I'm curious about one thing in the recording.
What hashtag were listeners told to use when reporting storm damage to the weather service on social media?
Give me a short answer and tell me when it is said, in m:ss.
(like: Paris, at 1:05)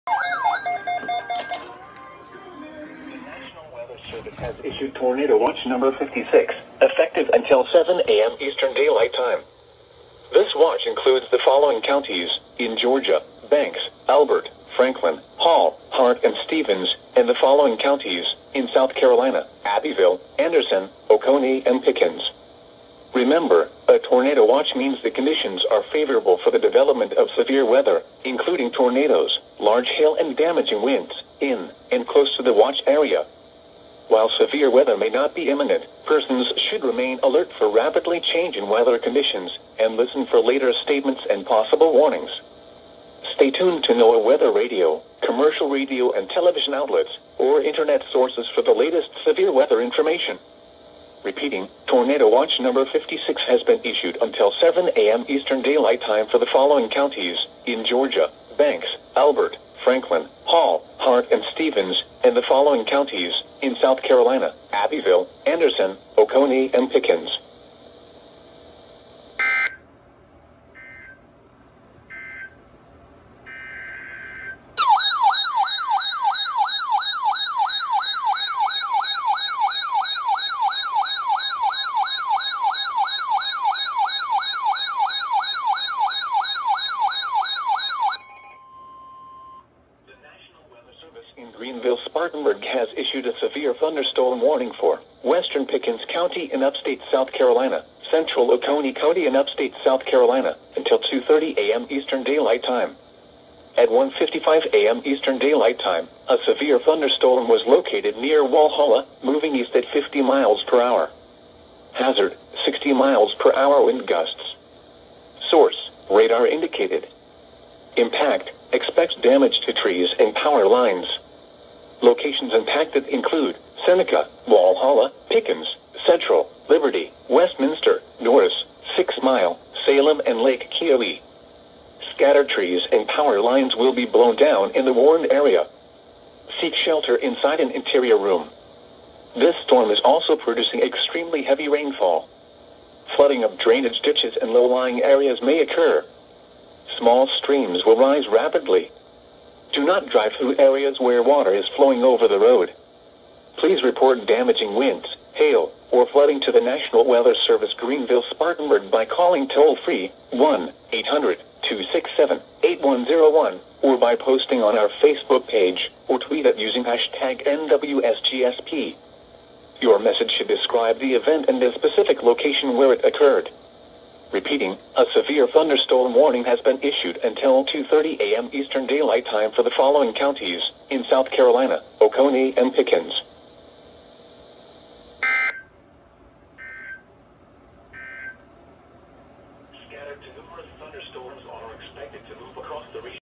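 NWSGSP, at 2:47.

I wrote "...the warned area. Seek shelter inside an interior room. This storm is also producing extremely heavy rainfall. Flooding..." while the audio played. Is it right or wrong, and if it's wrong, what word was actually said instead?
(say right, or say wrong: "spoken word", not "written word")
right.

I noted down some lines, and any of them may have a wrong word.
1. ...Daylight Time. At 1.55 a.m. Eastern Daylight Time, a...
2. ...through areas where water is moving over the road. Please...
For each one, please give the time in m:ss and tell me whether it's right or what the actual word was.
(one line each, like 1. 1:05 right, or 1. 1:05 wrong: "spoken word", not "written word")
1. 1:42 right
2. 2:30 wrong: "flowing", not "moving".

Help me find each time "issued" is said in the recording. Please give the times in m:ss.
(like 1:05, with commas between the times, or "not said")
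0:04, 0:53, 1:32, 2:56.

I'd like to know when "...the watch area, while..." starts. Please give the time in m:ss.
0:32.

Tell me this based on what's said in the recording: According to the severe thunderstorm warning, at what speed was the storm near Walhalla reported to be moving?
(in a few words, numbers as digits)
50 mph.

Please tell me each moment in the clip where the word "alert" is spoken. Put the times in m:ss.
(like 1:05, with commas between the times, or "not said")
0:37.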